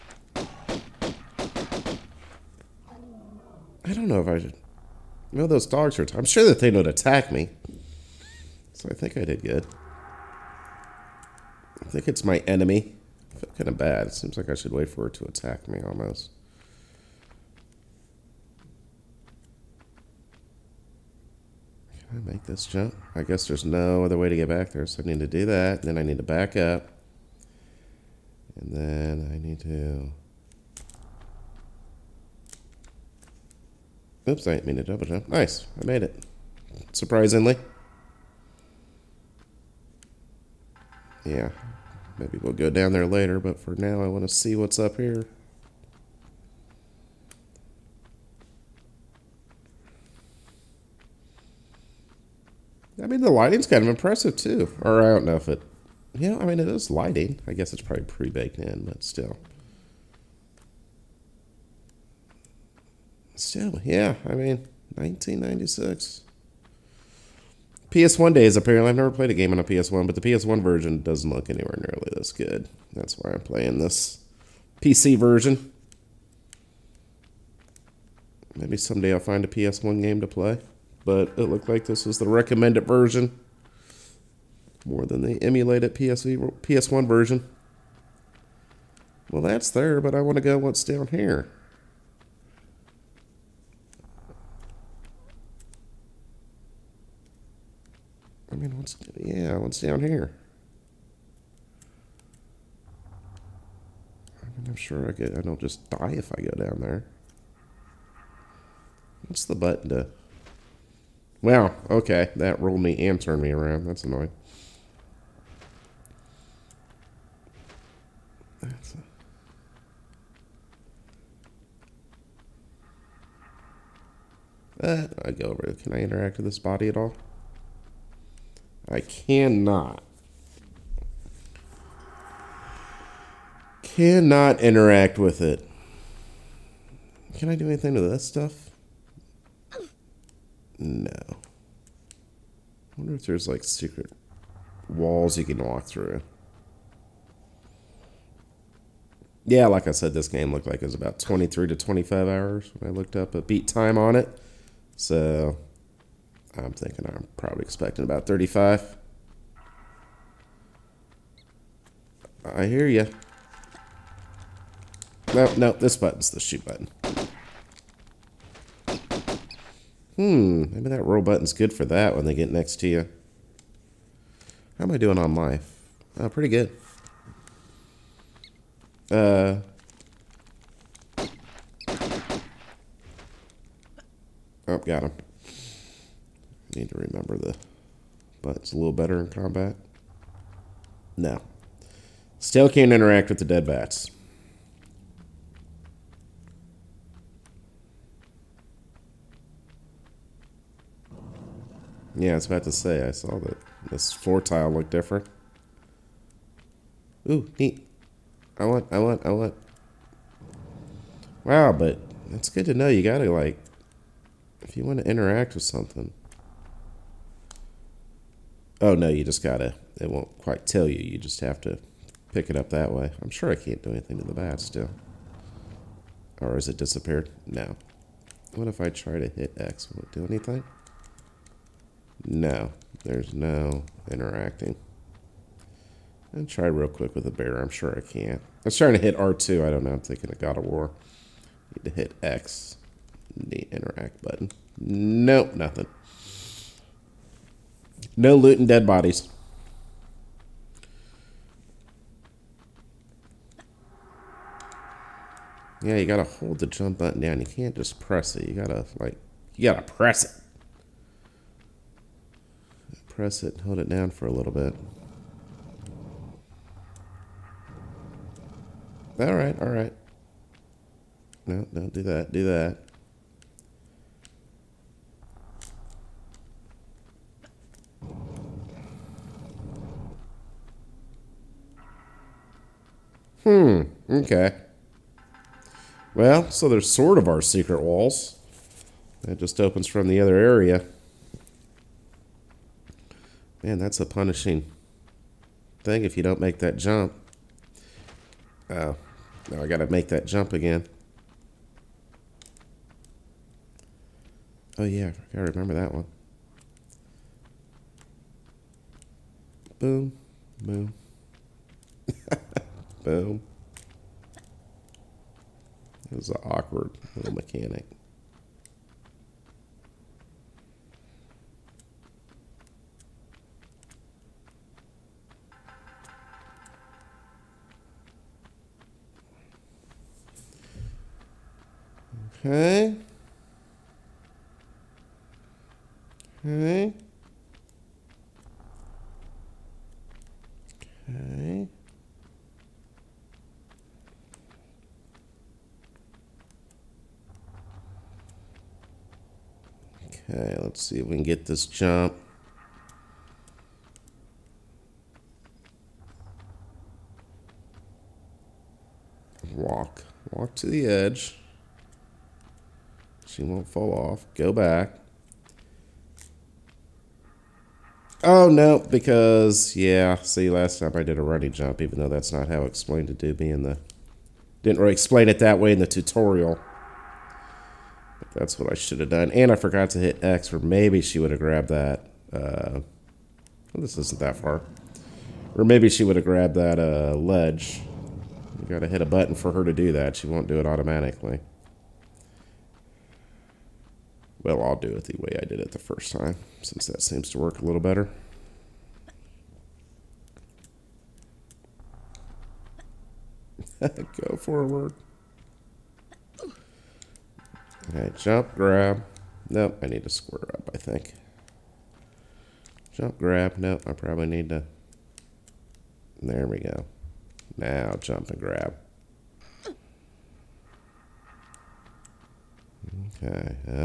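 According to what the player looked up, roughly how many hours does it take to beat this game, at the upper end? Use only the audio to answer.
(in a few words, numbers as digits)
25 hours.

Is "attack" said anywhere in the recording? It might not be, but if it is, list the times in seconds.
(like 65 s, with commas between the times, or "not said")
6 s, 15 s.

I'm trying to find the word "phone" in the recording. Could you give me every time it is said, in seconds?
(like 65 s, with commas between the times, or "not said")
not said.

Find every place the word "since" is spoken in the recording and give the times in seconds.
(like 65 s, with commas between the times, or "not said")
396 s.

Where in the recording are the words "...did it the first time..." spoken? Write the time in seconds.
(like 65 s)
395 s.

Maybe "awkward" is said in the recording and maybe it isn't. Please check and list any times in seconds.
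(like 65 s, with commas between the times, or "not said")
316 s.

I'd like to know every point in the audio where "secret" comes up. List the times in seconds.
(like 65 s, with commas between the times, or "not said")
143 s, 287 s.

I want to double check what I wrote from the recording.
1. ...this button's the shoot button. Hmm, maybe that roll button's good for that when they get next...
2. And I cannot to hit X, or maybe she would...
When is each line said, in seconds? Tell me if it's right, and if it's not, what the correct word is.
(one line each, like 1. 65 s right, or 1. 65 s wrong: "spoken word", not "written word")
1. 165 s right
2. 379 s wrong: "forgot", not "cannot".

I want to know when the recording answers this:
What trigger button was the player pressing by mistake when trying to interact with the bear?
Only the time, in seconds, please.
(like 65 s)
239 s.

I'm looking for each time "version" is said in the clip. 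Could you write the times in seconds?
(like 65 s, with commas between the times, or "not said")
70 s, 75 s, 82 s, 87 s.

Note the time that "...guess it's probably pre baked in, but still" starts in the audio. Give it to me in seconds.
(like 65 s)
57 s.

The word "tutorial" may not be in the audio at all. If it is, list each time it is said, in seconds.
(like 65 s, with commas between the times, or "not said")
375 s.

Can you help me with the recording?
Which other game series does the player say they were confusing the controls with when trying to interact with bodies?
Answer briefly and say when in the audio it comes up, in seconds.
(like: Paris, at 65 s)
God of War, at 240 s.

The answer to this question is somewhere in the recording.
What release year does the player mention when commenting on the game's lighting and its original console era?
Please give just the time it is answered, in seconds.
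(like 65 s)
64 s.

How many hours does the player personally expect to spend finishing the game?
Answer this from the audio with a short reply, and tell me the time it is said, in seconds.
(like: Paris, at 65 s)
35, at 158 s.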